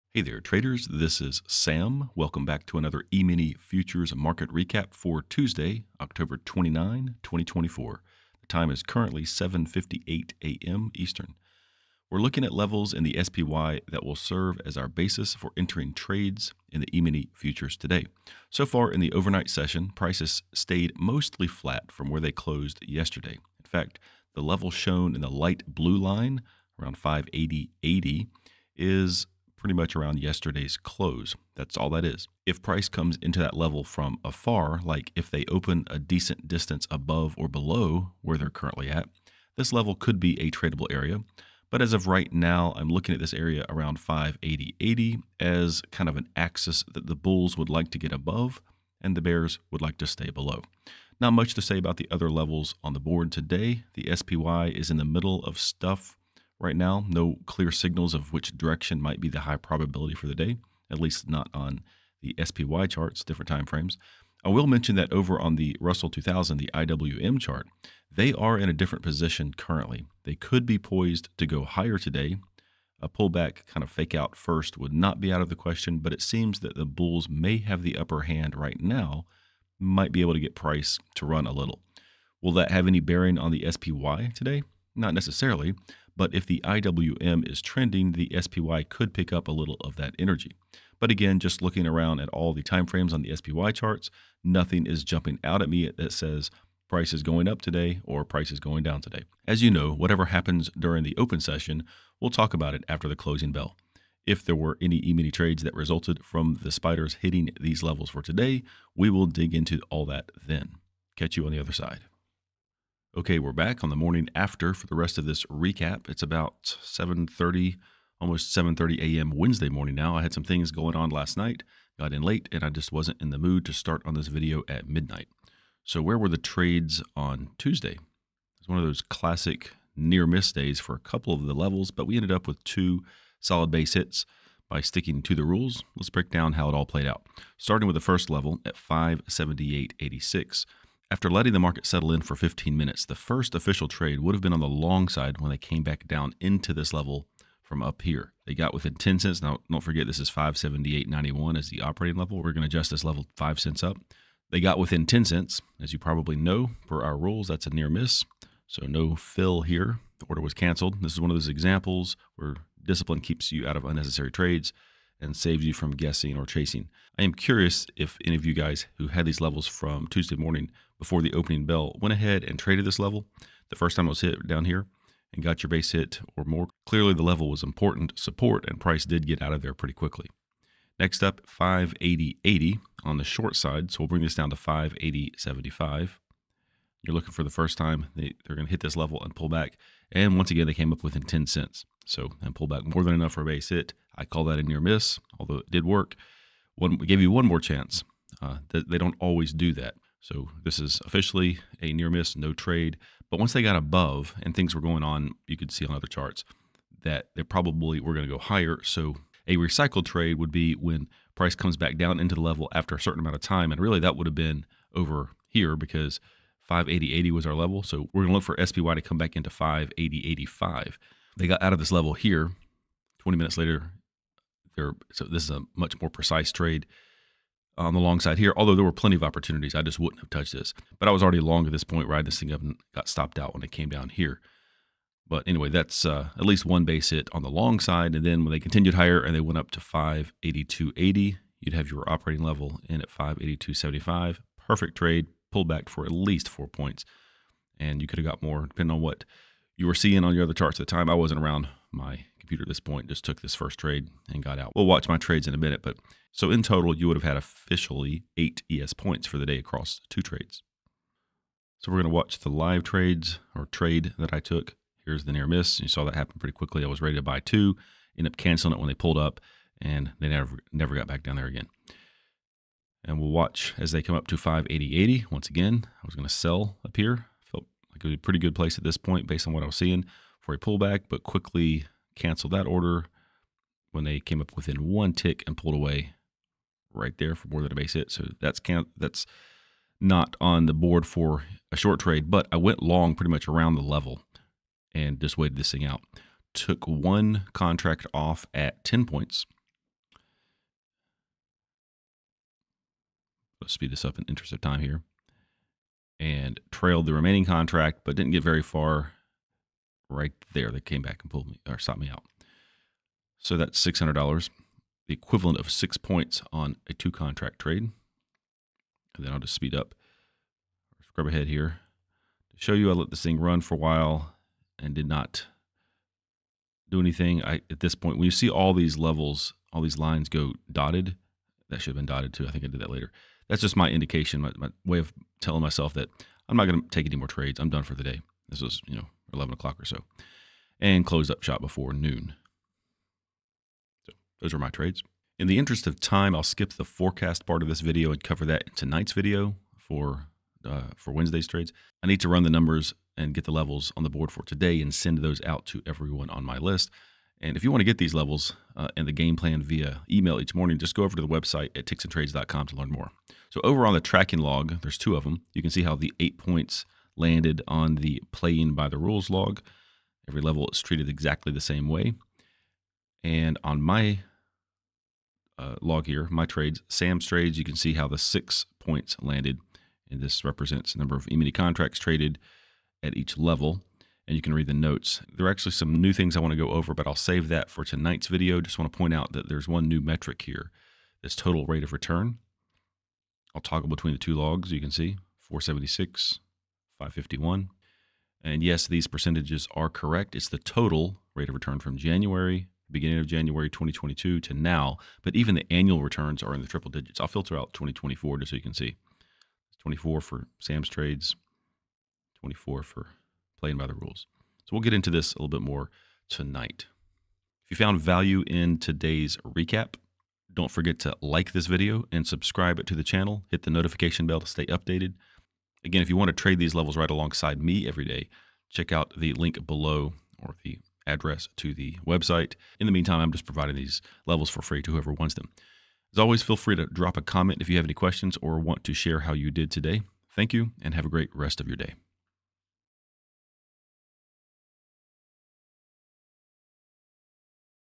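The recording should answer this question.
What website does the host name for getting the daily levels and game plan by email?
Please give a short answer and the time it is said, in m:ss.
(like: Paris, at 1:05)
ticksandtrades.com, at 6:01.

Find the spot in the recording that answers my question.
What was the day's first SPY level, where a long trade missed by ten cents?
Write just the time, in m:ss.
2:18.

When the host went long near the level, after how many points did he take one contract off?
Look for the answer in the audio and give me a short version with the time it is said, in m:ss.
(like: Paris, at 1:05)
10, at 4:58.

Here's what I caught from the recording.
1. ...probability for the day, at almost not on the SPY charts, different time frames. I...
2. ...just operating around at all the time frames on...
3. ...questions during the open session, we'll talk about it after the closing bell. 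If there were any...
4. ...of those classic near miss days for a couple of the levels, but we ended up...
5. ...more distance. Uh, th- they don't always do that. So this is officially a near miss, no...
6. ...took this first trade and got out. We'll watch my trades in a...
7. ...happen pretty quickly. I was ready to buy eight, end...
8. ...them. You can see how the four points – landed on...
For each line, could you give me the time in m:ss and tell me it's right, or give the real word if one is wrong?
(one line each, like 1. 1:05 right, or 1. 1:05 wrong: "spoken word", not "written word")
1. 0:59 wrong: "least", not "almost"
2. 1:31 wrong: "looking", not "operating"
3. 1:40 wrong: "happens", not "questions"
4. 2:08 right
5. 3:17 wrong: "chance", not "distance"
6. 4:13 right
7. 4:26 wrong: "two", not "eight"
8. 6:05 wrong: "eight", not "four".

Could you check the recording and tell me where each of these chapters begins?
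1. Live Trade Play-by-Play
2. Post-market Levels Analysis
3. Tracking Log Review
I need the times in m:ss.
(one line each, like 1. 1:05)
1. 4:20
2. 1:51
3. 5:44.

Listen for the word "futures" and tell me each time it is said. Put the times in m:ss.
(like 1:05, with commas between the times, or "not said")
0:03, 0:17.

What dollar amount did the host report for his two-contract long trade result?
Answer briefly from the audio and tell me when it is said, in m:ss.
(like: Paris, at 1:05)
$600, at 5:13.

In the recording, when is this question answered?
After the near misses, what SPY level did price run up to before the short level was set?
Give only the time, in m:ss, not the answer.
3:59.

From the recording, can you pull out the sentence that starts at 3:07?
You're looking for the first time they, they're going to hit this level and pull back.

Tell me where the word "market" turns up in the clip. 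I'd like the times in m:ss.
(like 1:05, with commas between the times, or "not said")
0:04, 2:21.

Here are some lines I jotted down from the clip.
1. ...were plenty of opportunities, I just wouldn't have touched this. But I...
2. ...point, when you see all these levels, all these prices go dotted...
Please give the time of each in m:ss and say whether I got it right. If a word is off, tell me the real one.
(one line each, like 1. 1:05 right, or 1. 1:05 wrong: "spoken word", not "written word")
1. 3:48 right
2. 5:27 wrong: "lines", not "prices".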